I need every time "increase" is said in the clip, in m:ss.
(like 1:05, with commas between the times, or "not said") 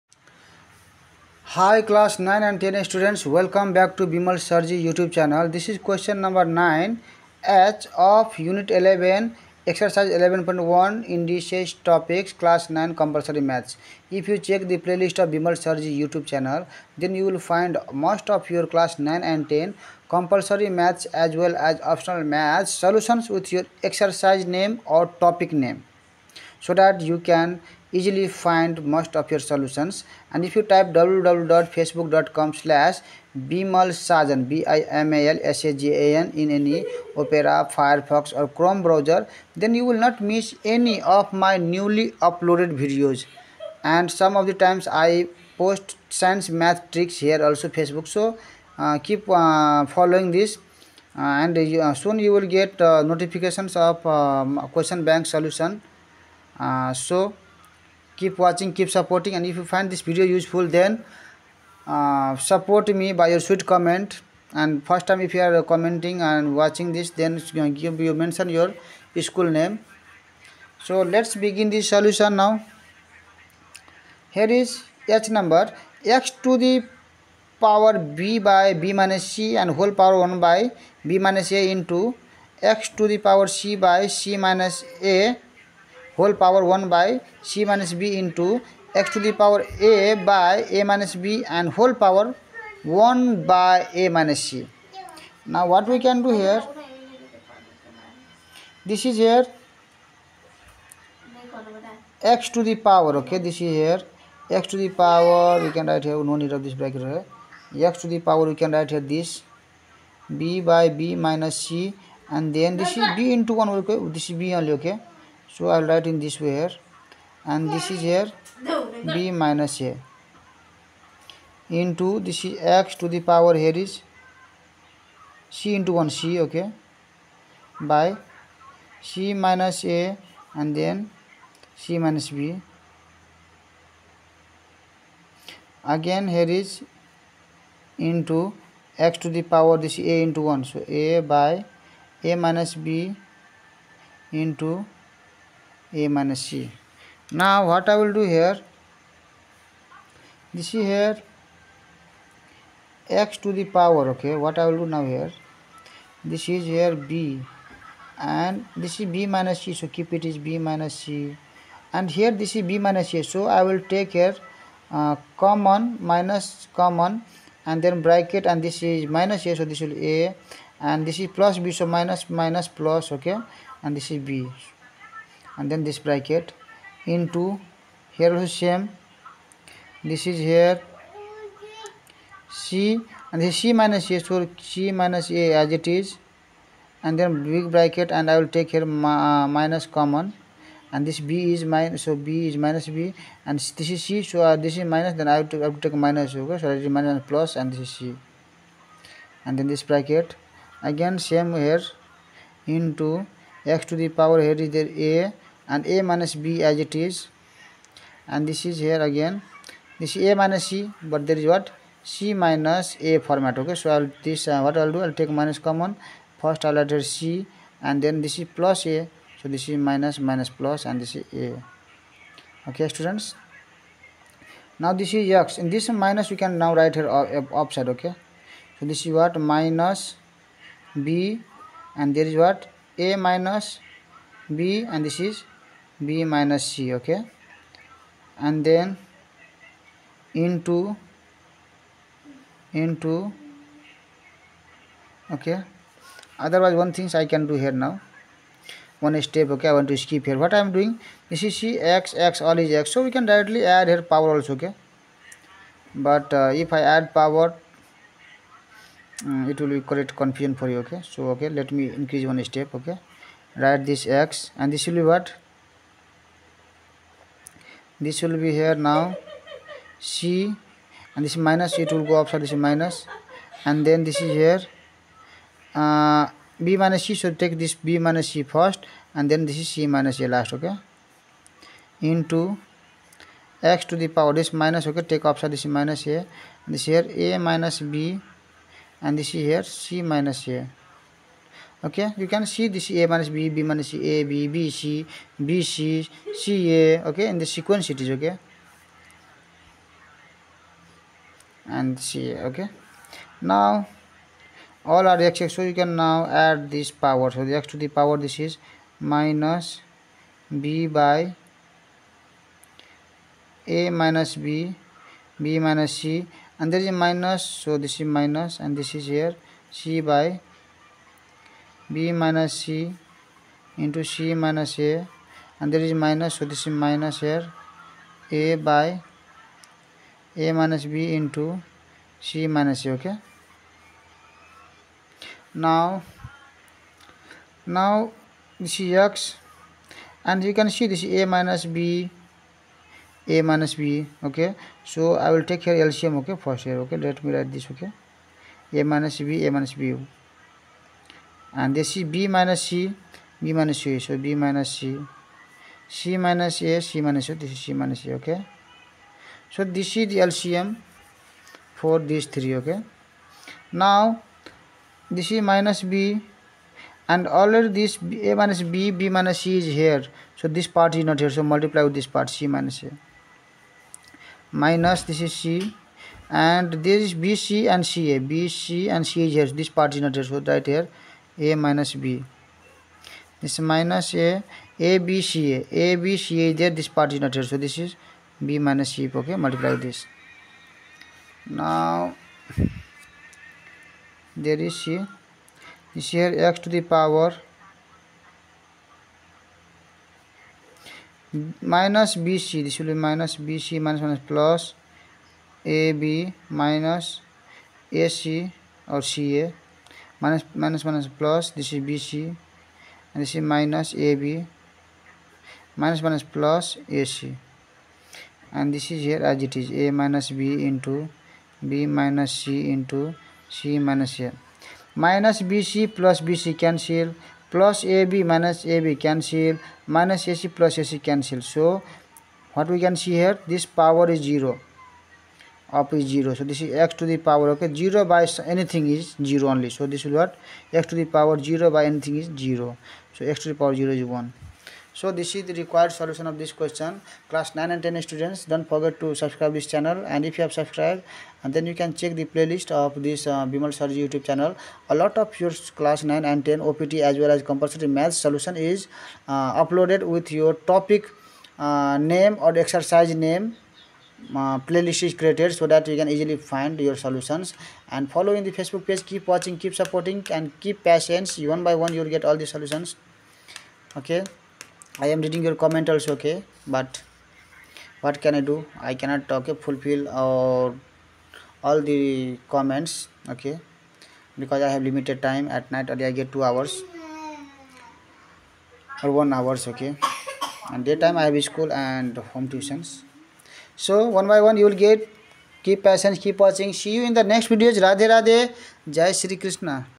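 4:21.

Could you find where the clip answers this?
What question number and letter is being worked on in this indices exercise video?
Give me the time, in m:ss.
0:05.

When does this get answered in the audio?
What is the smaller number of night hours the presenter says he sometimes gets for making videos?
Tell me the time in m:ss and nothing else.
8:09.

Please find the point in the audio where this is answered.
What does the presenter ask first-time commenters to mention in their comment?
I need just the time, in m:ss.
1:09.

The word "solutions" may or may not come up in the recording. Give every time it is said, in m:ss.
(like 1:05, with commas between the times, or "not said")
0:22, 0:29, 0:55, 1:11, 7:25, 7:38, 7:46, 7:52.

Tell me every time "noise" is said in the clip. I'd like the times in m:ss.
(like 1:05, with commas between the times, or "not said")
not said.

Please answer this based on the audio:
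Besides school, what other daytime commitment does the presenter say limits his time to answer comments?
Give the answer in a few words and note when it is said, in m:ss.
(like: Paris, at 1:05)
home tuitions, at 8:12.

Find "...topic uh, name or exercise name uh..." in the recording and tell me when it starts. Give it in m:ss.
7:40.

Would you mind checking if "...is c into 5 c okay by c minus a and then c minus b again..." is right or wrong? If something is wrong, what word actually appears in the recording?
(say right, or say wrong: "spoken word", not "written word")
wrong: "1", not "5".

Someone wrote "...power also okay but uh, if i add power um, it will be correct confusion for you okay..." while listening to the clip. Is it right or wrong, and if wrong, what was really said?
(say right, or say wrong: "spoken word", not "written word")
right.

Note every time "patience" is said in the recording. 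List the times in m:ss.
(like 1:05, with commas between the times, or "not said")
7:50, 8:15.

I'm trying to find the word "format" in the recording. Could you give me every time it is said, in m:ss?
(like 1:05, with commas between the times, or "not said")
3:33.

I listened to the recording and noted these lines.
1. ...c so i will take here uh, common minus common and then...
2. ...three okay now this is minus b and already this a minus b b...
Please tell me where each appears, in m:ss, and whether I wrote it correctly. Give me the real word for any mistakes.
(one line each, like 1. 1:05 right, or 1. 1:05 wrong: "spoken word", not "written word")
1. 2:43 right
2. 6:02 right.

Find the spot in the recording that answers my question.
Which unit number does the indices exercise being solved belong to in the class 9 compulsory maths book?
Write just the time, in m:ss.
0:08.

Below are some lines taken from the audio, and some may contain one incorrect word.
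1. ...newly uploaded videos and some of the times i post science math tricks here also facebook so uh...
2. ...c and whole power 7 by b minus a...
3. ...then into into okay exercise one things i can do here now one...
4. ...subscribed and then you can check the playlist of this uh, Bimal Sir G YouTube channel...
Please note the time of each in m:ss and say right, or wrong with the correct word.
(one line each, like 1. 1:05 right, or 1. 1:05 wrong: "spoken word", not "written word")
1. 0:41 right
2. 1:19 wrong: "1", not "7"
3. 3:58 wrong: "otherwise", not "exercise"
4. 7:30 right.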